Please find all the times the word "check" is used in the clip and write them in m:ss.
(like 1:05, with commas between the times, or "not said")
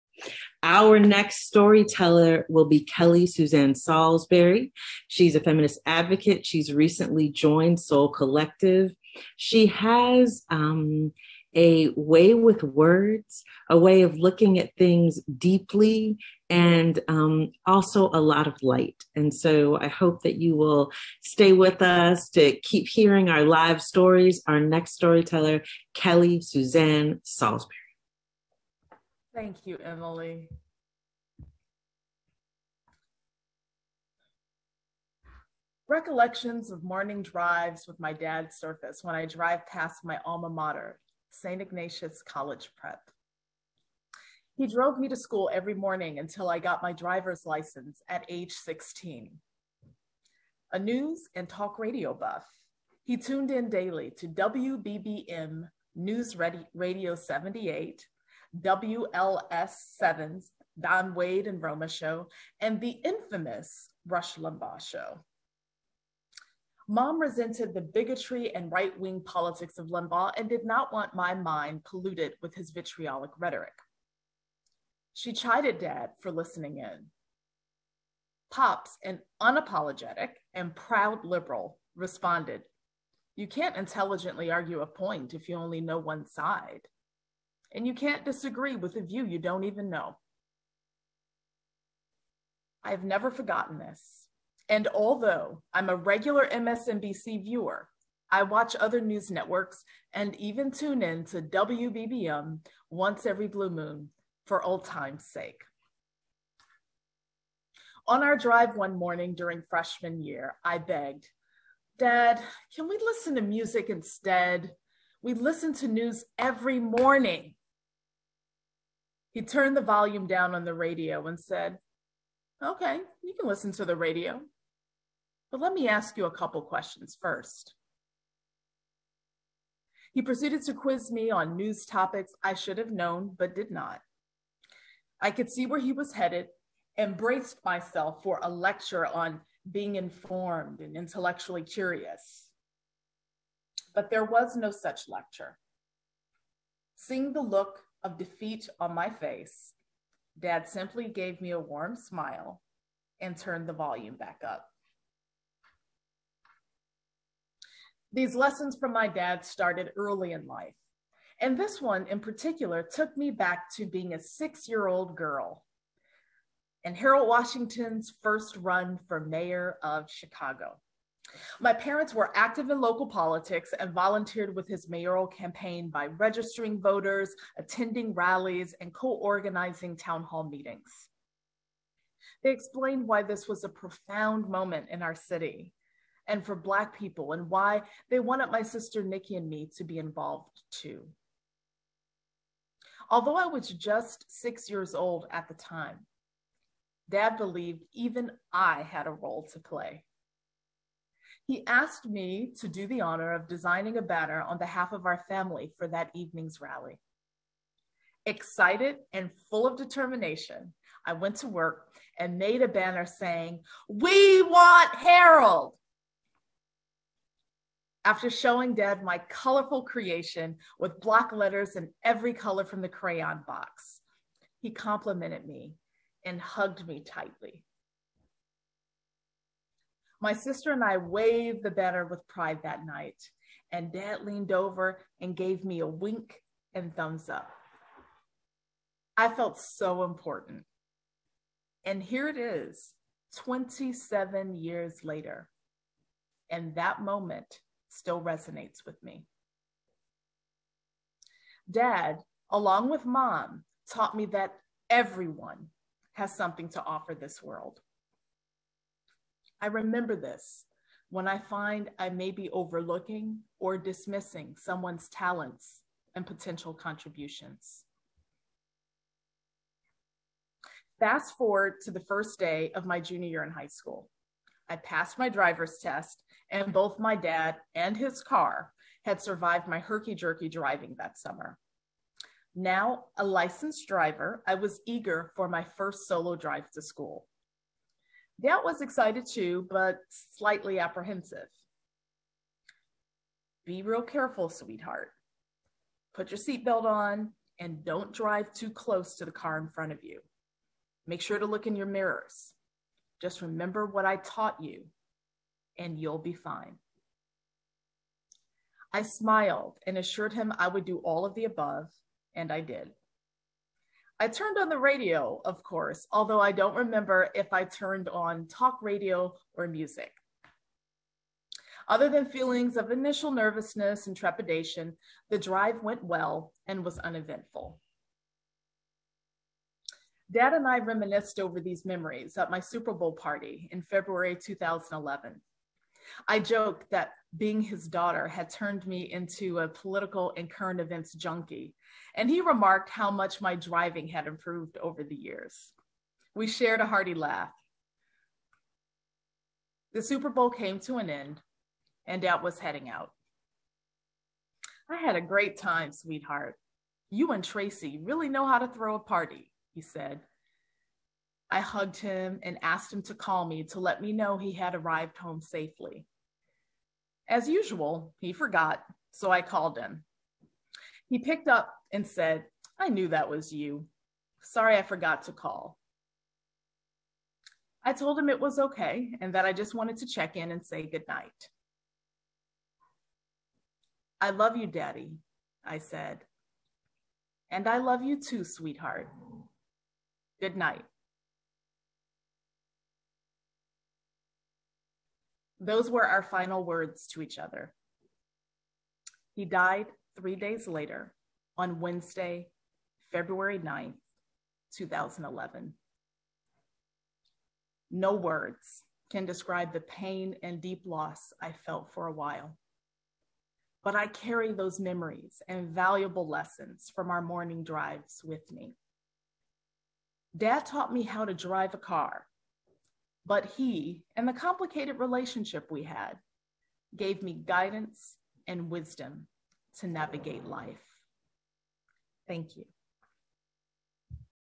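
6:20.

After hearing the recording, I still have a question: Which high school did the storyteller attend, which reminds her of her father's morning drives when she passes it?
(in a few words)
St. Ignatius College Prep.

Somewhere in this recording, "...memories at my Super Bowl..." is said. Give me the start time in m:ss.
5:31.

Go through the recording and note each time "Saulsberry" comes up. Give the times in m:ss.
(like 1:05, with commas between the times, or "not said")
0:03, 0:27.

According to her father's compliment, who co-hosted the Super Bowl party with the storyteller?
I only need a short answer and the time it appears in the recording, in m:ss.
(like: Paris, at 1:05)
Tracy, at 5:57.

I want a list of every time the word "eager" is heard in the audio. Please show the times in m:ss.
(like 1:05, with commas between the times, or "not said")
4:44.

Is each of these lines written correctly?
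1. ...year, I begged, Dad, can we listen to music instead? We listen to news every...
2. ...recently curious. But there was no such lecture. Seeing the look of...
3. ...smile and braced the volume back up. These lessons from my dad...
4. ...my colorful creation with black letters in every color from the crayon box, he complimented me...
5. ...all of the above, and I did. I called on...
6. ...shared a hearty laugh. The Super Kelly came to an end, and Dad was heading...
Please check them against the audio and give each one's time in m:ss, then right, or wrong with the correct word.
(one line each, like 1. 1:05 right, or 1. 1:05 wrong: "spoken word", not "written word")
1. 1:50 right
2. 2:20 wrong: "intellectually", not "recently"
3. 2:31 wrong: "turned", not "braced"
4. 3:39 right
5. 5:10 wrong: "turned", not "called"
6. 5:46 wrong: "Bowl", not "Kelly".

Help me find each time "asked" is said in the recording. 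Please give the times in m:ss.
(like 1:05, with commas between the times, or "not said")
3:21, 6:02.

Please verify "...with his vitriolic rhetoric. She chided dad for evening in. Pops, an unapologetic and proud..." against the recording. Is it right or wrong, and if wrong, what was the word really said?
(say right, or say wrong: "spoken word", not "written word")
wrong: "listening", not "evening".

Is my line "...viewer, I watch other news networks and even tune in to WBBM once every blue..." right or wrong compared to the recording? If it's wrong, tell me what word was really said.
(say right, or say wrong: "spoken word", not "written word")
right.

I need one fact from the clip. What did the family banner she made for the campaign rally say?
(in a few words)
We want Harold.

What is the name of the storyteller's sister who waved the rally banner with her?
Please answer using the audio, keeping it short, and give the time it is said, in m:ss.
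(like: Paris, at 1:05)
Nikki, at 3:09.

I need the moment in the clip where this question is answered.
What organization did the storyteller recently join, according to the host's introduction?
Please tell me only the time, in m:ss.
0:07.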